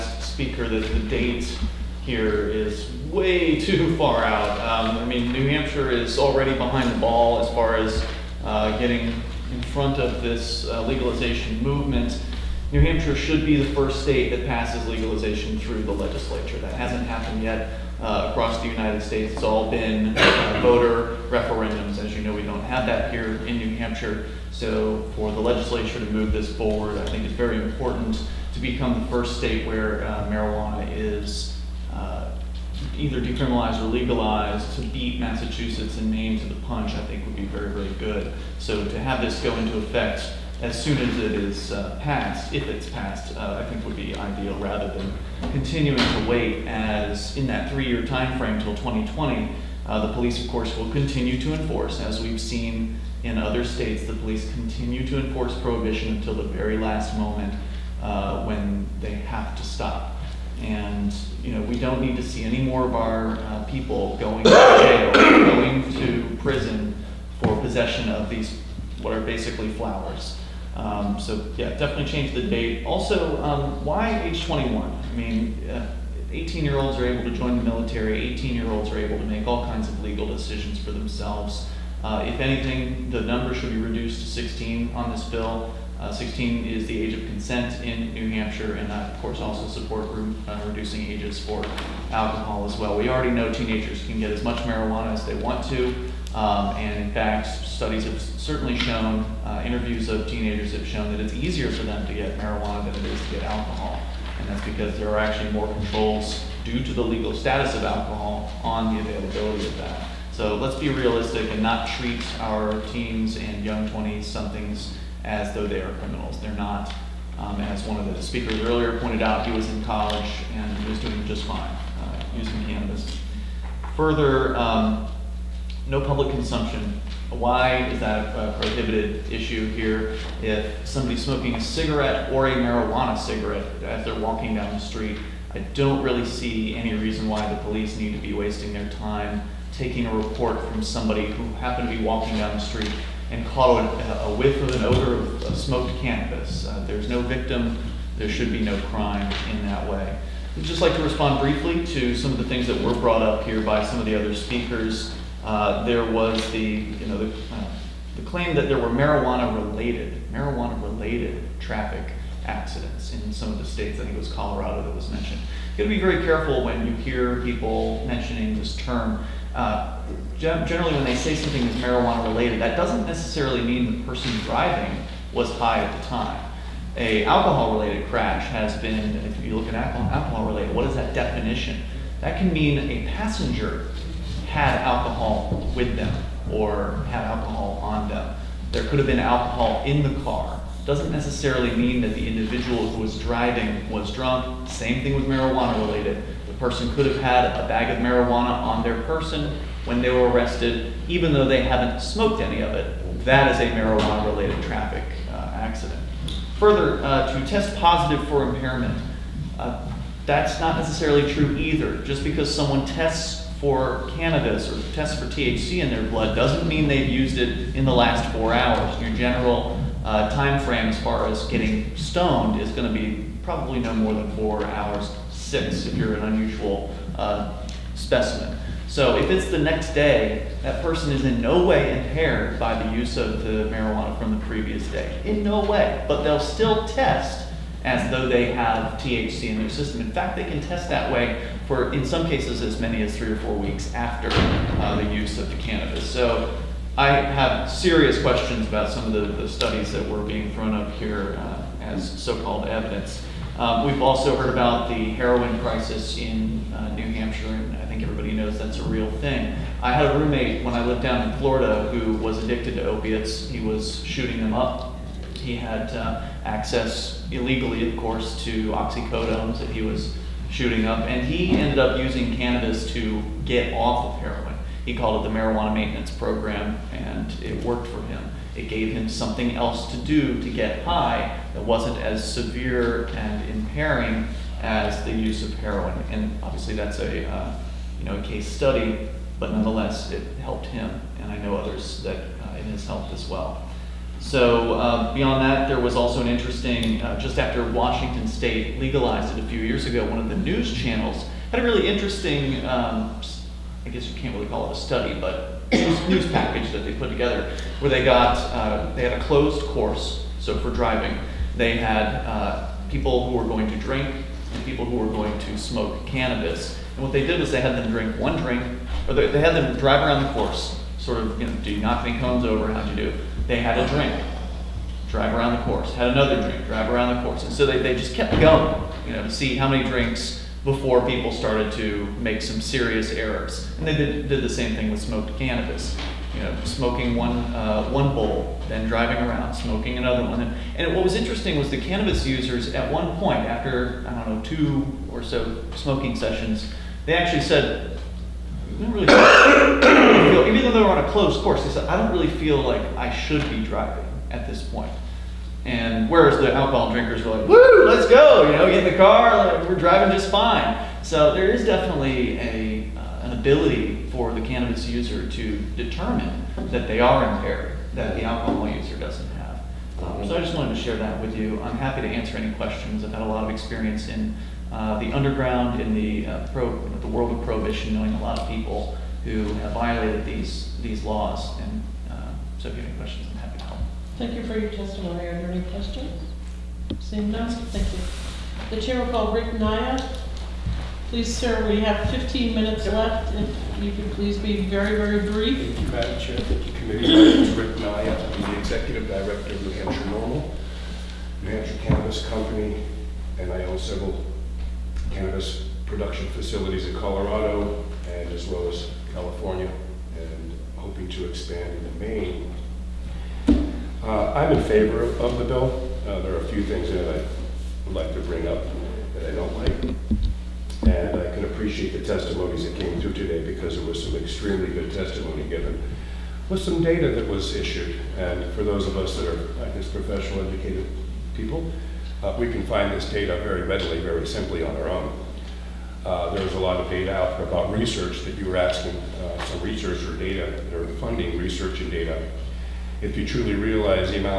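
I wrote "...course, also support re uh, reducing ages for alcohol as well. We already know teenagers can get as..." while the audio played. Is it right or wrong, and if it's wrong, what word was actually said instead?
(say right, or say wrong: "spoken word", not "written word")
right.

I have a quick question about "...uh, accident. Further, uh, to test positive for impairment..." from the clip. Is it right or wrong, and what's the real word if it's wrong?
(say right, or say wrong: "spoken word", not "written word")
right.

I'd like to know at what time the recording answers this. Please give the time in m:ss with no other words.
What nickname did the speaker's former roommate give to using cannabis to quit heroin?
4:35.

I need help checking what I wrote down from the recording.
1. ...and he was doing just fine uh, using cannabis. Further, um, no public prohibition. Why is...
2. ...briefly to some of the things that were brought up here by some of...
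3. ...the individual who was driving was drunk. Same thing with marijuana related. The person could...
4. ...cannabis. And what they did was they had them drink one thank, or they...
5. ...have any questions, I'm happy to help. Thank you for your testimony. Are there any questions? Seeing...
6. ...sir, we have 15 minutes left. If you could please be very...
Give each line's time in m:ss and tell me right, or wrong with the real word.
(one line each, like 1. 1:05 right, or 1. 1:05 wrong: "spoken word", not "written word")
1. 2:00 wrong: "consumption", not "prohibition"
2. 2:31 right
3. 3:12 right
4. 5:16 wrong: "drink", not "thank"
5. 6:22 right
6. 6:31 right.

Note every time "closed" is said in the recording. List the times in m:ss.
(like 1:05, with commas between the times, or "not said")
5:09, 5:51.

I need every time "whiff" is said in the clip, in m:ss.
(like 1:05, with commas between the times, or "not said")
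2:24.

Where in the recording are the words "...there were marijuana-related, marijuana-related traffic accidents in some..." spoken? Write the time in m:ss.
2:38.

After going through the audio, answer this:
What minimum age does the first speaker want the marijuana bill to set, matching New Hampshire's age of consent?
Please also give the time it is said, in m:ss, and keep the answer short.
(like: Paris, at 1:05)
16, at 1:23.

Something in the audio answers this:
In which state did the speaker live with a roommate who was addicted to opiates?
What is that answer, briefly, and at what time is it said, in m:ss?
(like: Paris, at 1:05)
Florida, at 4:21.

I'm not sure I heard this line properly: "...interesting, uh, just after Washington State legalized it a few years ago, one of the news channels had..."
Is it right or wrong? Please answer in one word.
right.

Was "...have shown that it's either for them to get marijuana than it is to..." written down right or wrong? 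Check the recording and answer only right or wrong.
wrong.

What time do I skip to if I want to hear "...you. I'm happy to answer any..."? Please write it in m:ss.
6:11.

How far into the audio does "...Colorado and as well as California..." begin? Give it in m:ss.
6:46.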